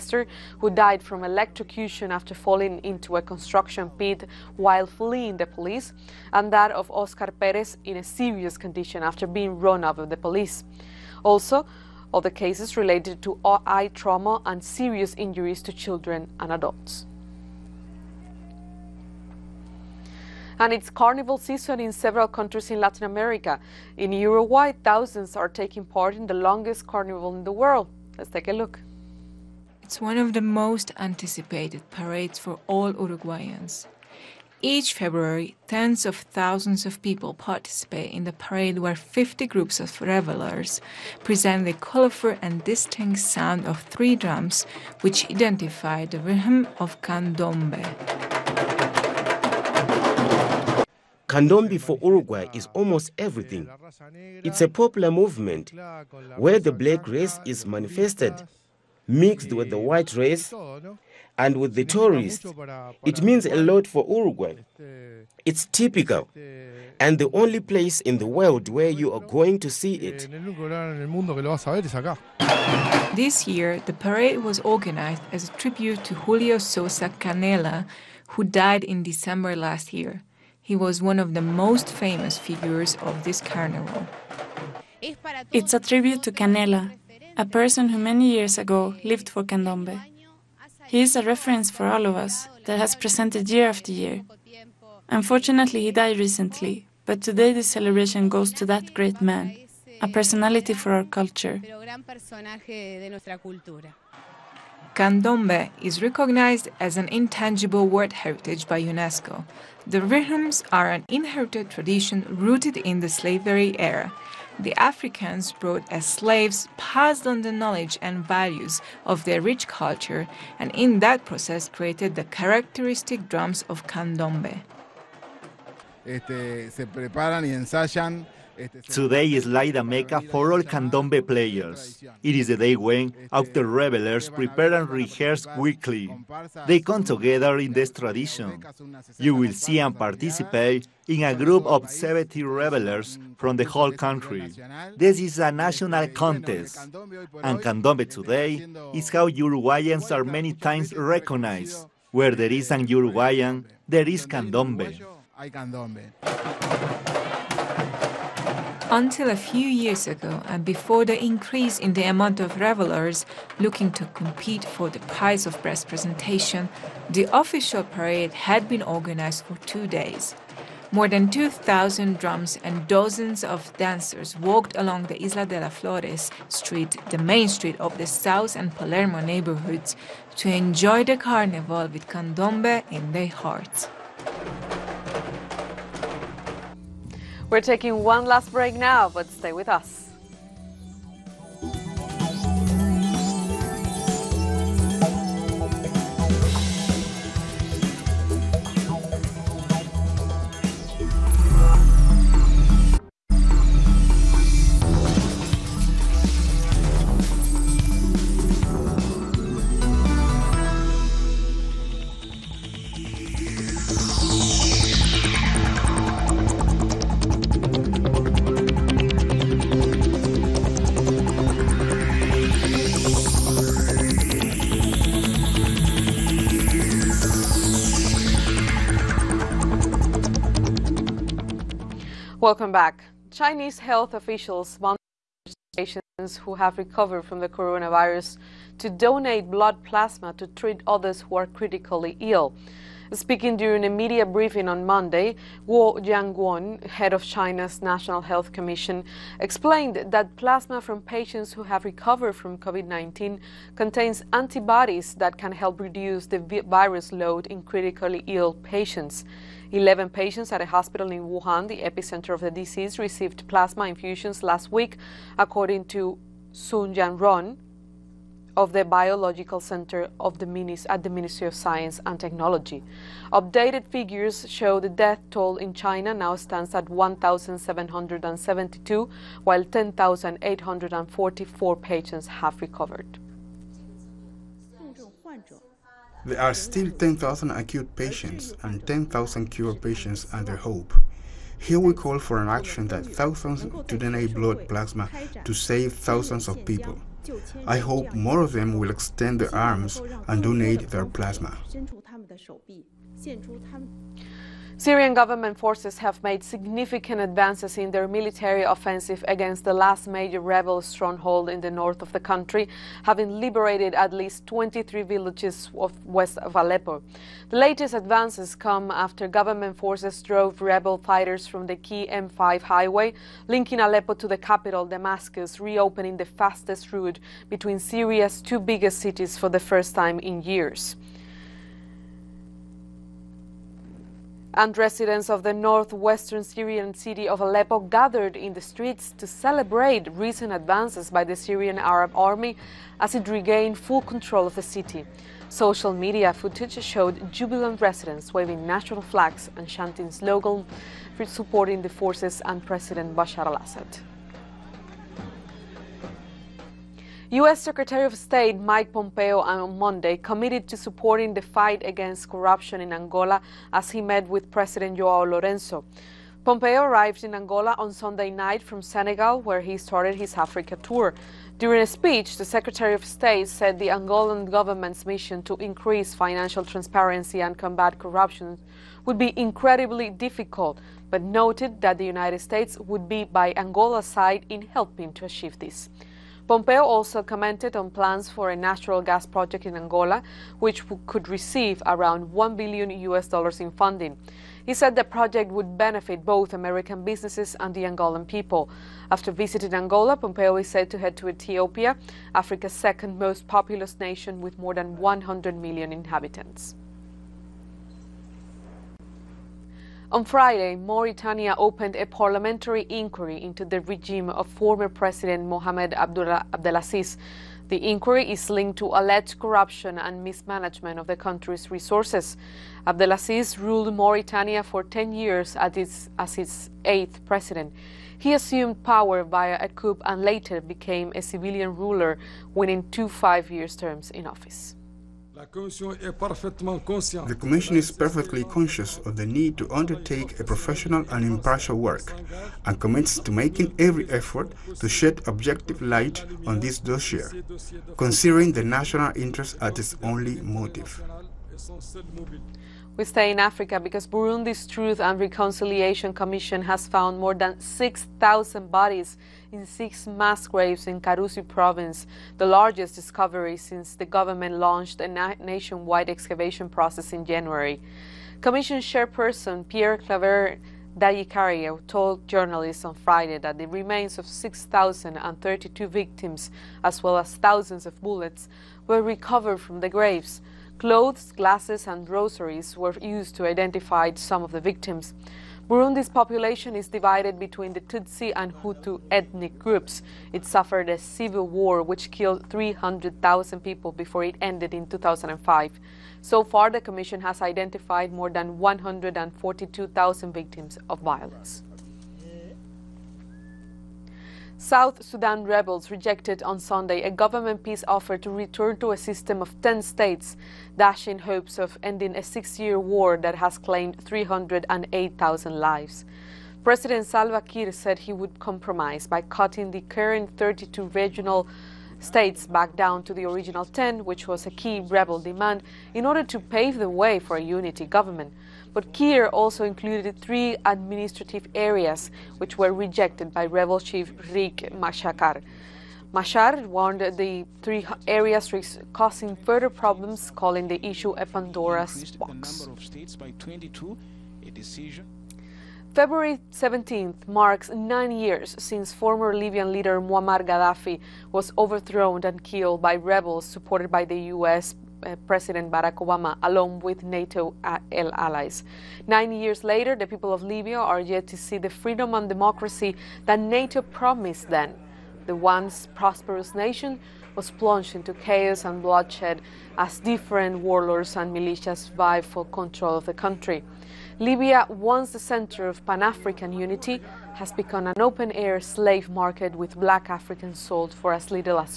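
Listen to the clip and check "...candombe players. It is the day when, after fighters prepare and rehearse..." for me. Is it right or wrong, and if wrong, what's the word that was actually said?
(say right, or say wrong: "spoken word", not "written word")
wrong: "revelers", not "fighters".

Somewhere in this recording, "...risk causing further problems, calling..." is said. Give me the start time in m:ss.
8:58.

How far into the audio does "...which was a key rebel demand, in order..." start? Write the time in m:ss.
8:44.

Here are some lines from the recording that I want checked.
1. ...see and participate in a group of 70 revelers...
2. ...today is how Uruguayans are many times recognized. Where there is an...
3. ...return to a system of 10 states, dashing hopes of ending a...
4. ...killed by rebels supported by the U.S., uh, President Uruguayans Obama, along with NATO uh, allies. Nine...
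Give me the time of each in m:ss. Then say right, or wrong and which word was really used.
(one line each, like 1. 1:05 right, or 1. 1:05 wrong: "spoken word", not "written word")
1. 2:19 right
2. 2:28 right
3. 8:28 right
4. 9:12 wrong: "Barack", not "Uruguayans".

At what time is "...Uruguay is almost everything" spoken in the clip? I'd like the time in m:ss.
0:52.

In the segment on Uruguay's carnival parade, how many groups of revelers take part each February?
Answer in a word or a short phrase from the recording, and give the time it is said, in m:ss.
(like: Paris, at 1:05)
50, at 0:38.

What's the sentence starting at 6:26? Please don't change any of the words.
Pompeo also commented on plans for a natural gas project in Angola, which could receive around 1 billion US dollars in funding.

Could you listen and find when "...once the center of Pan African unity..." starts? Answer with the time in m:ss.
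9:34.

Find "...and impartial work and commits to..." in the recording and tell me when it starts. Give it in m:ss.
7:21.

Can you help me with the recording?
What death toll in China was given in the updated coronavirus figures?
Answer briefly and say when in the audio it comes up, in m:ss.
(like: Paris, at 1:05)
1,772, at 4:36.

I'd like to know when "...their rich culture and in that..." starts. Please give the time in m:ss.
1:59.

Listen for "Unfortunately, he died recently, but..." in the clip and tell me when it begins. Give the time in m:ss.
1:35.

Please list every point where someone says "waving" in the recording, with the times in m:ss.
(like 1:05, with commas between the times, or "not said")
5:48.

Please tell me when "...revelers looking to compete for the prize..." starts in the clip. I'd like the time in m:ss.
2:42.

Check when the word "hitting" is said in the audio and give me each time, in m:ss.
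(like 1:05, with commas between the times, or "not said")
not said.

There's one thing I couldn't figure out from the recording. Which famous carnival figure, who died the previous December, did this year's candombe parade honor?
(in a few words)
Julio Sosa Canela.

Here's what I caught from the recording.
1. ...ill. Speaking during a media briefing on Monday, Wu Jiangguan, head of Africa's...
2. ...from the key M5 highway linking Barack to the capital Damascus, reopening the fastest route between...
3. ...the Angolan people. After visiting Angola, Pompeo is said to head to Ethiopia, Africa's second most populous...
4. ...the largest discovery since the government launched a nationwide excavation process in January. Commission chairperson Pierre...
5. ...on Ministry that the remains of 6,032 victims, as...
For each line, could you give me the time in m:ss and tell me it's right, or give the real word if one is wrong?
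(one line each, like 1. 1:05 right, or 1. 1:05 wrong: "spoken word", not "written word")
1. 4:02 wrong: "China", not "Africa"
2. 5:21 wrong: "Aleppo", not "Barack"
3. 6:37 right
4. 7:42 right
5. 7:52 wrong: "Friday", not "Ministry".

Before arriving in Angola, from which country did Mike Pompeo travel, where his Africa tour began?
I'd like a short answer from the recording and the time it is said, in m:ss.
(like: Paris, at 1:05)
Senegal, at 6:08.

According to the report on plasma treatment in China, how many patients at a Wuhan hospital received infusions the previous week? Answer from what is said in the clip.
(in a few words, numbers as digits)
11.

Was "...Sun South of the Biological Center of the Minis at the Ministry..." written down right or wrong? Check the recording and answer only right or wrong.
wrong.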